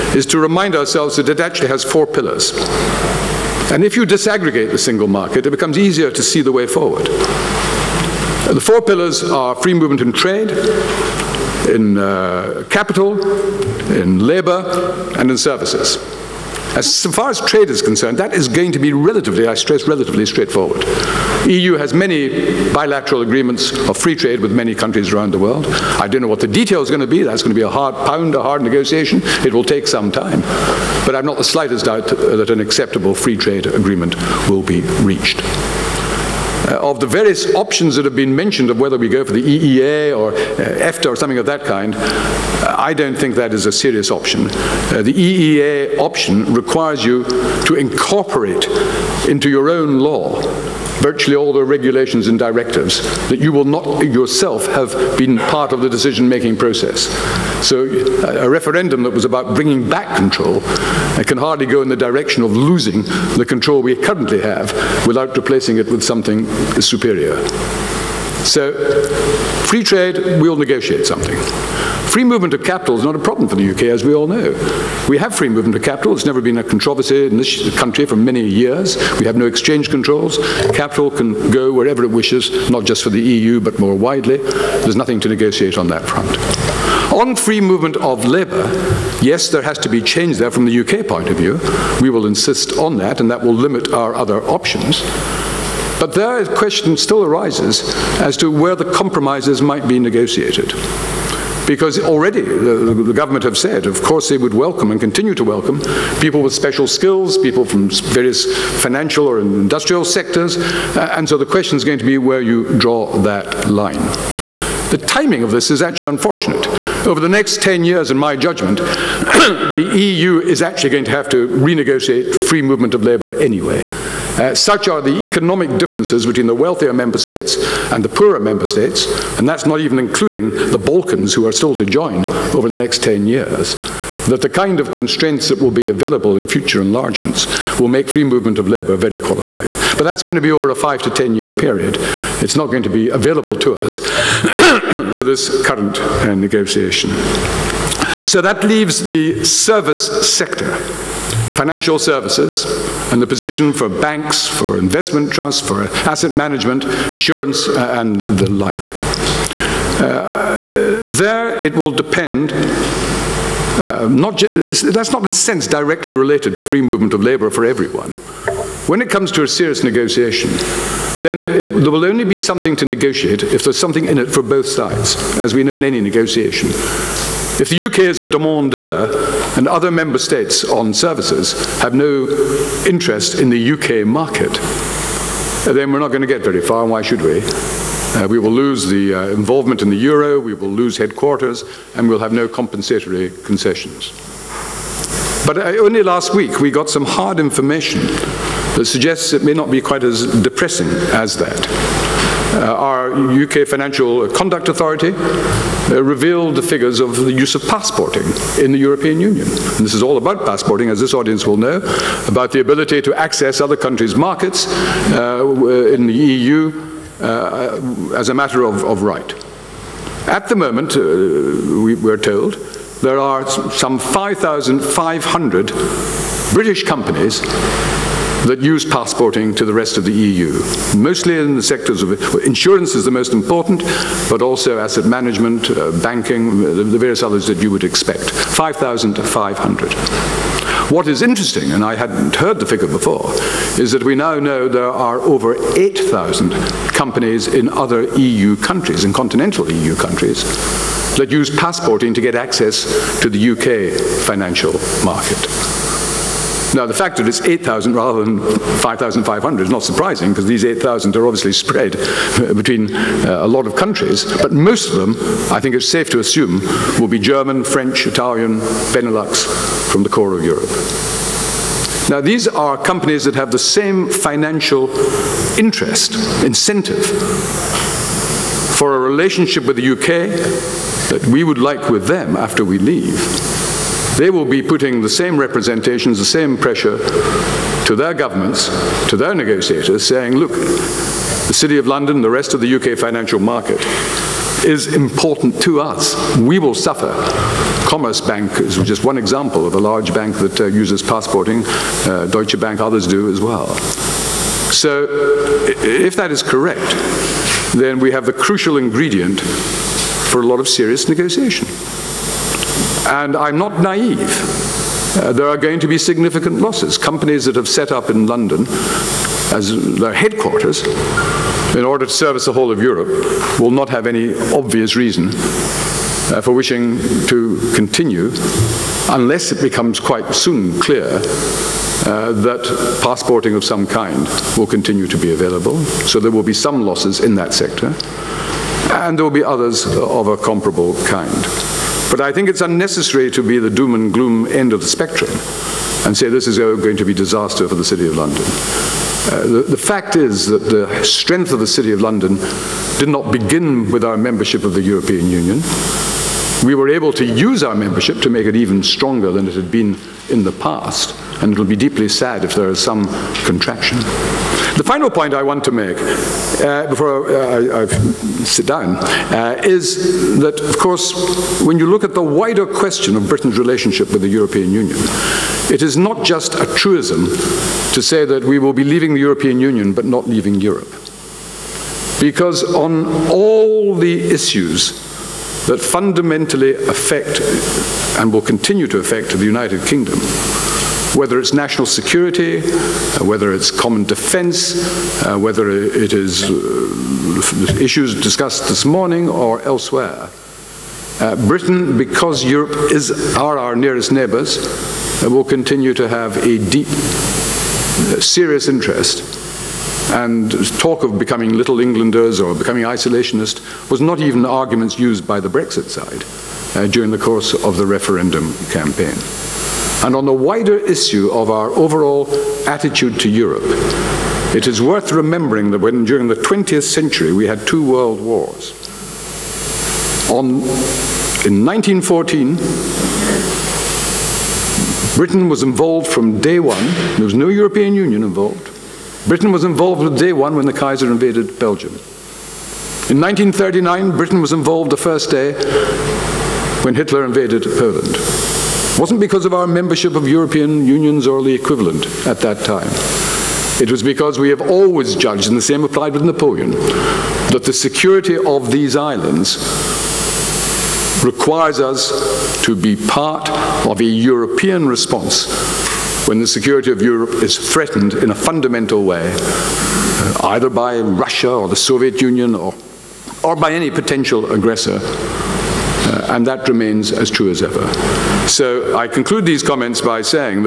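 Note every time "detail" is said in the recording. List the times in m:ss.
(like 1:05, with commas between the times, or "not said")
0:26.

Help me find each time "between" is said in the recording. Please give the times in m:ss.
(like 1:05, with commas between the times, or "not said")
2:06, 4:22.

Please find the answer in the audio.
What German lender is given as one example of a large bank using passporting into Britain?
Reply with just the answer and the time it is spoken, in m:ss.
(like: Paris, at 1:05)
Commerzbank, at 4:57.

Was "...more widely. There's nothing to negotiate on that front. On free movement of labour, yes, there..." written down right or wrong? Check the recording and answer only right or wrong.
right.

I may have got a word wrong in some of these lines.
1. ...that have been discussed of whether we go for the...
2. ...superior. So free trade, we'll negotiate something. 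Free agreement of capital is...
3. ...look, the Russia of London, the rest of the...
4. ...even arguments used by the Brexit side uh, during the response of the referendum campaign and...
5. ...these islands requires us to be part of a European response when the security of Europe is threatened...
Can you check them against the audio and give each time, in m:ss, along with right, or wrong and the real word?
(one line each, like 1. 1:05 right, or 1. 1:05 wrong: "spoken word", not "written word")
1. 0:37 wrong: "mentioned", not "discussed"
2. 1:06 wrong: "movement", not "agreement"
3. 4:50 wrong: "City", not "Russia"
4. 6:54 wrong: "course", not "response"
5. 7:38 right.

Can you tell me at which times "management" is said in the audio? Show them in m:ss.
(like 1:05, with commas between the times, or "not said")
2:36, 3:55.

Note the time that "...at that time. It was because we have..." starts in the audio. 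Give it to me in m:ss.
7:32.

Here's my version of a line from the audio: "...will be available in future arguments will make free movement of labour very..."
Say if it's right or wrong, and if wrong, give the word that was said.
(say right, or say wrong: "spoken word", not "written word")
wrong: "enlargements", not "arguments".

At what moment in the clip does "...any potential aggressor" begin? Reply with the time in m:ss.
7:53.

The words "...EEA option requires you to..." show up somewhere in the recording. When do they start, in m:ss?
0:45.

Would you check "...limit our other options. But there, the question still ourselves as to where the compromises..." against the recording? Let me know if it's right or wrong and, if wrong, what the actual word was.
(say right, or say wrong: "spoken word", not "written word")
wrong: "arises", not "ourselves".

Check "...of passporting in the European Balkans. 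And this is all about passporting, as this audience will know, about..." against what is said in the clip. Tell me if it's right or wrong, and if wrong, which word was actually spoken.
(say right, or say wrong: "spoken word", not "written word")
wrong: "Union", not "Balkans".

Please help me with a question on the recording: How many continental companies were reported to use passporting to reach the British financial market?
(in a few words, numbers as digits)
Over 8,000.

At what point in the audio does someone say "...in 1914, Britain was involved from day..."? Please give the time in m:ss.
7:11.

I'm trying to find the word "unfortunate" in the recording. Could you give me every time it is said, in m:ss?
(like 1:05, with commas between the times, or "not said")
1:56.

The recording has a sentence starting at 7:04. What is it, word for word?
It is worth remembering that when during the 20th century we had two world wars.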